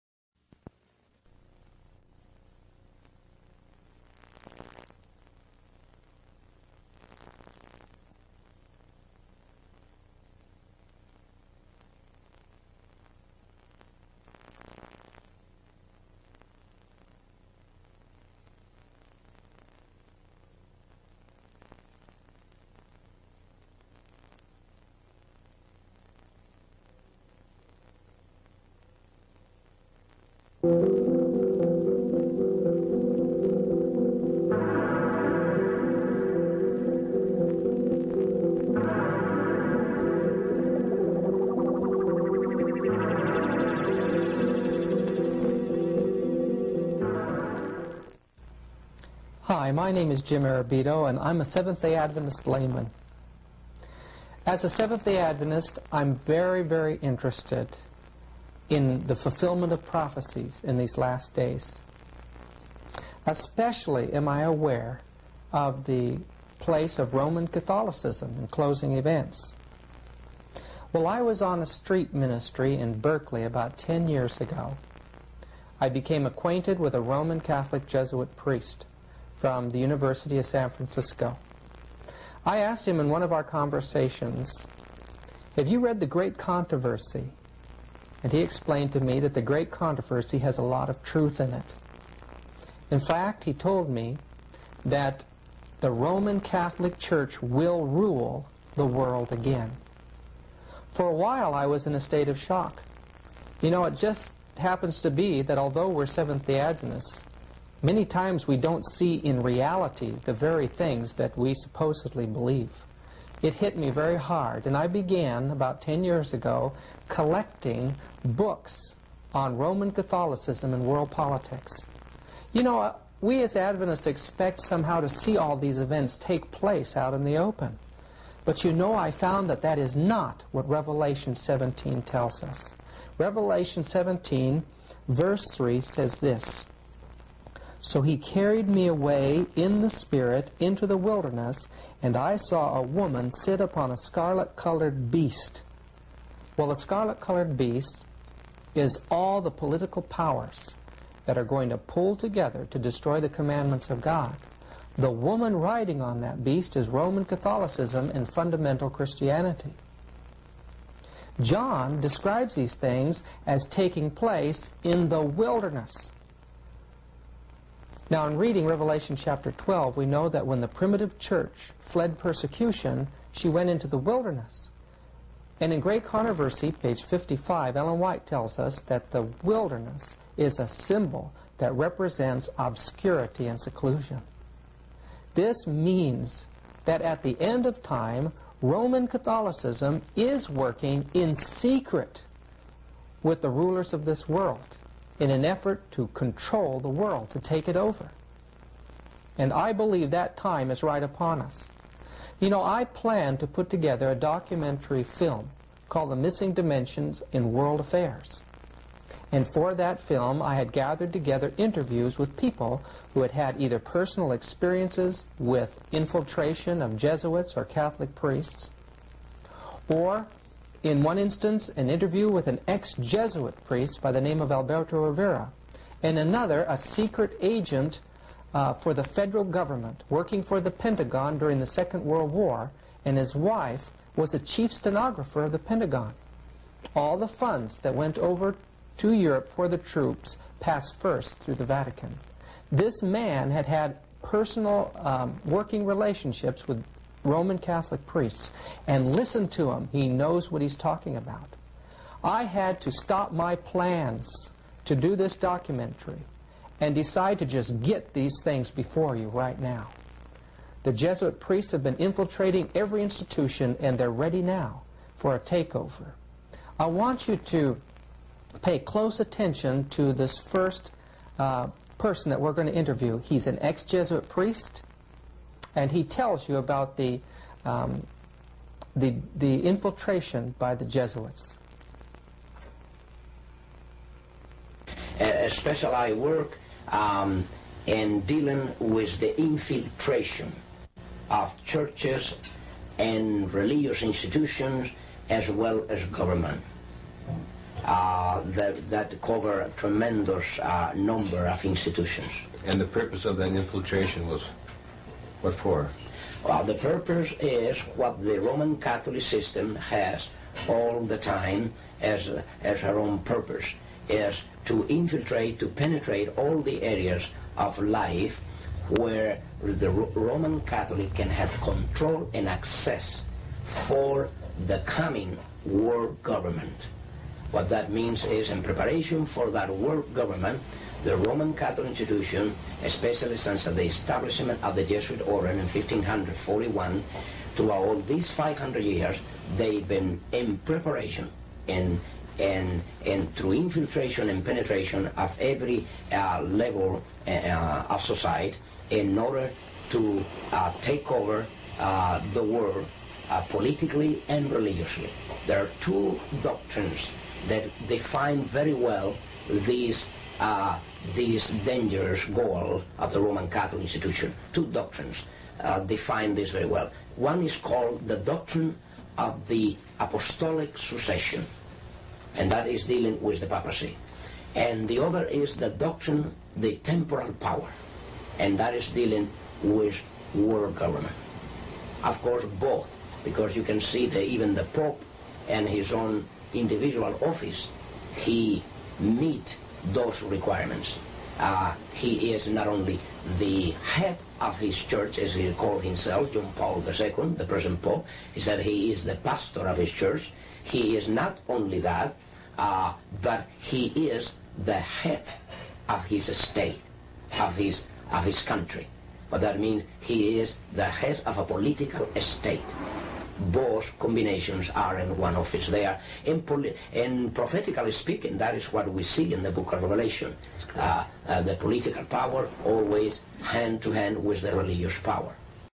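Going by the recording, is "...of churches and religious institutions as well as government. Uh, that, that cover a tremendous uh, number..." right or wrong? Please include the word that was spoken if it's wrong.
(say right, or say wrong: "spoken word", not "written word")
right.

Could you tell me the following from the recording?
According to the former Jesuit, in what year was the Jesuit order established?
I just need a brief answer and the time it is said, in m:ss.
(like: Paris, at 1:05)
1541, at 5:35.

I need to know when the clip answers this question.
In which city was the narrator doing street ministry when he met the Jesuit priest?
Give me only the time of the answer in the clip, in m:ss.
1:12.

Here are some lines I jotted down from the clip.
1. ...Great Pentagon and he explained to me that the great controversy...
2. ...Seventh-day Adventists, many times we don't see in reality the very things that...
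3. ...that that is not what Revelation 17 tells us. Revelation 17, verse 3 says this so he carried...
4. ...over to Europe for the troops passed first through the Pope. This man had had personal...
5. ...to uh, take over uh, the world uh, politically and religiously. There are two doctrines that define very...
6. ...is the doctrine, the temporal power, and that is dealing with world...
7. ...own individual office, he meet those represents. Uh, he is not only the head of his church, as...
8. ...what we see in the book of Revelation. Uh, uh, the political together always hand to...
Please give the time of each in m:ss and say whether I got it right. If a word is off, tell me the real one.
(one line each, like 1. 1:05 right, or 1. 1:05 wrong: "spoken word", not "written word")
1. 1:26 wrong: "Controversy", not "Pentagon"
2. 1:46 right
3. 2:09 right
4. 3:58 wrong: "Vatican", not "Pope"
5. 5:49 right
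6. 6:15 right
7. 6:25 wrong: "requirements", not "represents"
8. 6:58 wrong: "power", not "together".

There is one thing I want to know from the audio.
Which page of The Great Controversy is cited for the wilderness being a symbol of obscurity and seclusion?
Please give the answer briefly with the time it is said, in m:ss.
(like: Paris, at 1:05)
55, at 2:56.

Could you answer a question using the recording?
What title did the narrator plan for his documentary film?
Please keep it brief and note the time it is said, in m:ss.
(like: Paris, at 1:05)
The Missing Dimensions in World Affairs, at 3:26.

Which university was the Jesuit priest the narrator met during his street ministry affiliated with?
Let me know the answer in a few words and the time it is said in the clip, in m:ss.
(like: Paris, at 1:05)
University of San Francisco, at 1:19.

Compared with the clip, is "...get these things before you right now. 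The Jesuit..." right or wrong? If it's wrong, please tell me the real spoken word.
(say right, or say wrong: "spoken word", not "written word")
right.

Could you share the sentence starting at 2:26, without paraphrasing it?
Well, a scarlet-colored beast is all the political powers that are going to pull together to destroy the commandments of God.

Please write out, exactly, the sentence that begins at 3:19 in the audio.
And I believe that time is right upon us.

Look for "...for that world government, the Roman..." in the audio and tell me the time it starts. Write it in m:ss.
5:29.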